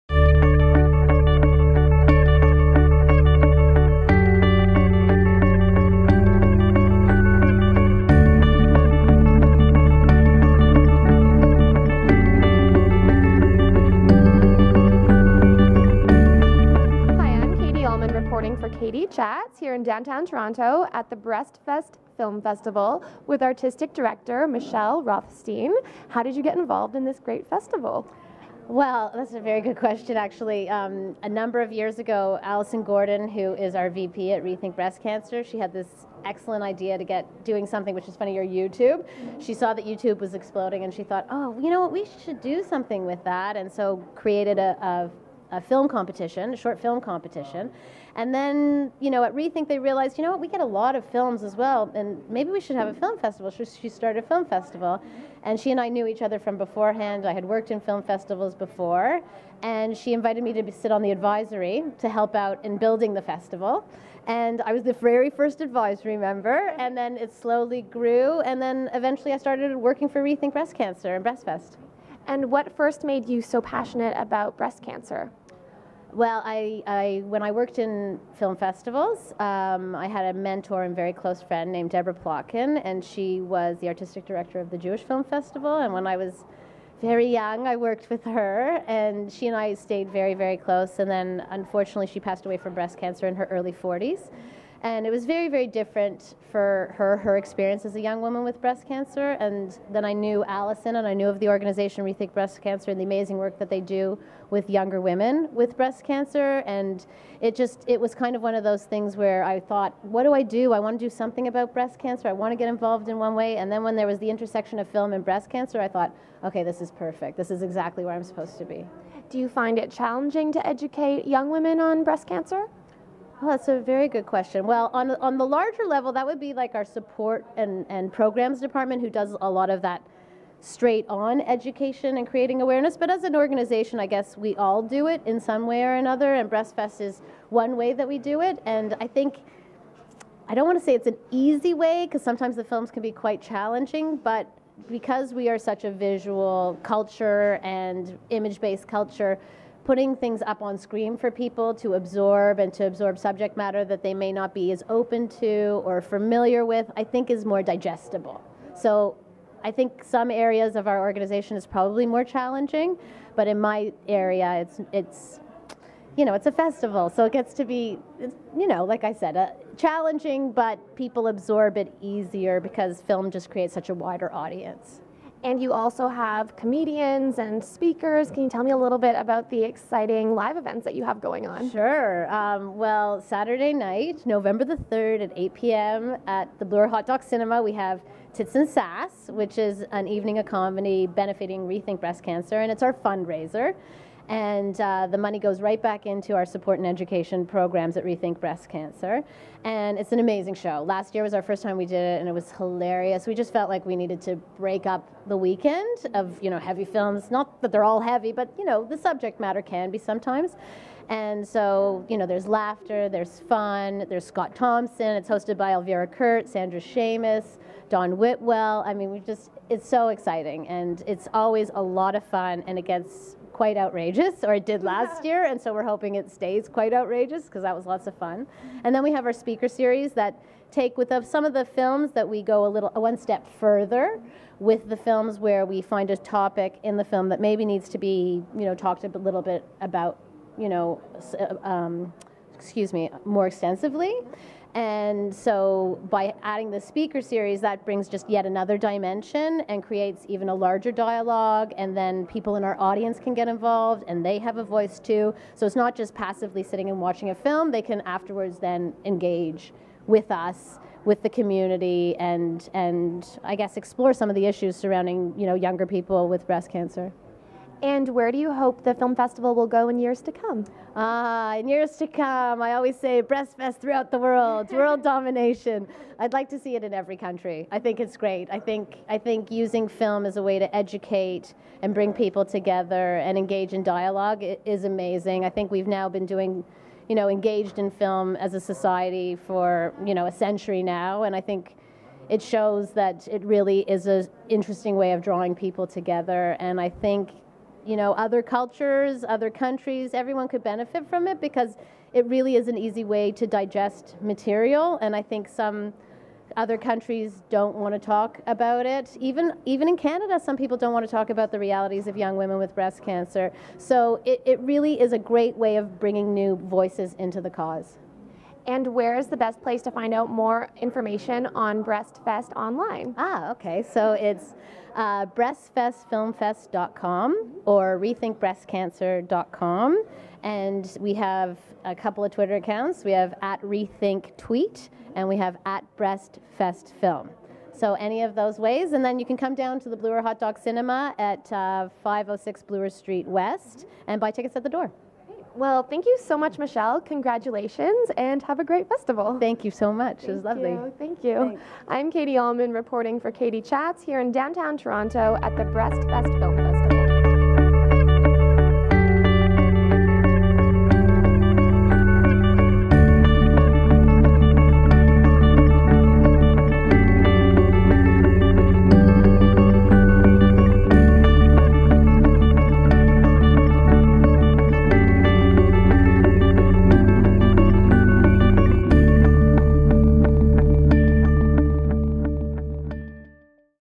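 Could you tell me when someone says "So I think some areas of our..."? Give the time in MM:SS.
02:38.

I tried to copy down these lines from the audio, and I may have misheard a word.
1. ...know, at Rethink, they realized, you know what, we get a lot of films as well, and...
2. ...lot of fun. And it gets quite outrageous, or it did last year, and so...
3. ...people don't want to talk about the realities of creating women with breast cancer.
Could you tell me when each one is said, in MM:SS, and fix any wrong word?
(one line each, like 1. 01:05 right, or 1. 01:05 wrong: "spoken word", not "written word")
1. 00:49 right
2. 03:41 right
3. 05:10 wrong: "young", not "creating".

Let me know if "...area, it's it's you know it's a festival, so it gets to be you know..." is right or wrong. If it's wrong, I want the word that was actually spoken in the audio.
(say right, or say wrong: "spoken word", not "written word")
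right.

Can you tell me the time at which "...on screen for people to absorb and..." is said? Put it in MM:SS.
02:30.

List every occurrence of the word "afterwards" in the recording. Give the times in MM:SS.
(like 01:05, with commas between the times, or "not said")
04:18.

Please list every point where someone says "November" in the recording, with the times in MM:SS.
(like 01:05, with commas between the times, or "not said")
03:04.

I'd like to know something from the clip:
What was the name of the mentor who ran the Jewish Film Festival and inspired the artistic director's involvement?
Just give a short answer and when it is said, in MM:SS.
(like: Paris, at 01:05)
Deborah Plotkin, at 01:21.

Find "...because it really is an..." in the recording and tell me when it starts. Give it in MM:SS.
05:01.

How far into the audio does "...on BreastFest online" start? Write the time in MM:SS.
05:21.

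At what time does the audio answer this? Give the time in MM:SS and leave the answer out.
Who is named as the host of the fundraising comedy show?
03:35.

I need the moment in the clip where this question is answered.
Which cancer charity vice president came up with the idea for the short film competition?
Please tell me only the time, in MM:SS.
00:32.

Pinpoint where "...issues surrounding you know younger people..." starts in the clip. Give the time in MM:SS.
04:24.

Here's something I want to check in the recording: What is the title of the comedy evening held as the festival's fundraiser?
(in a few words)
Tits and Sass.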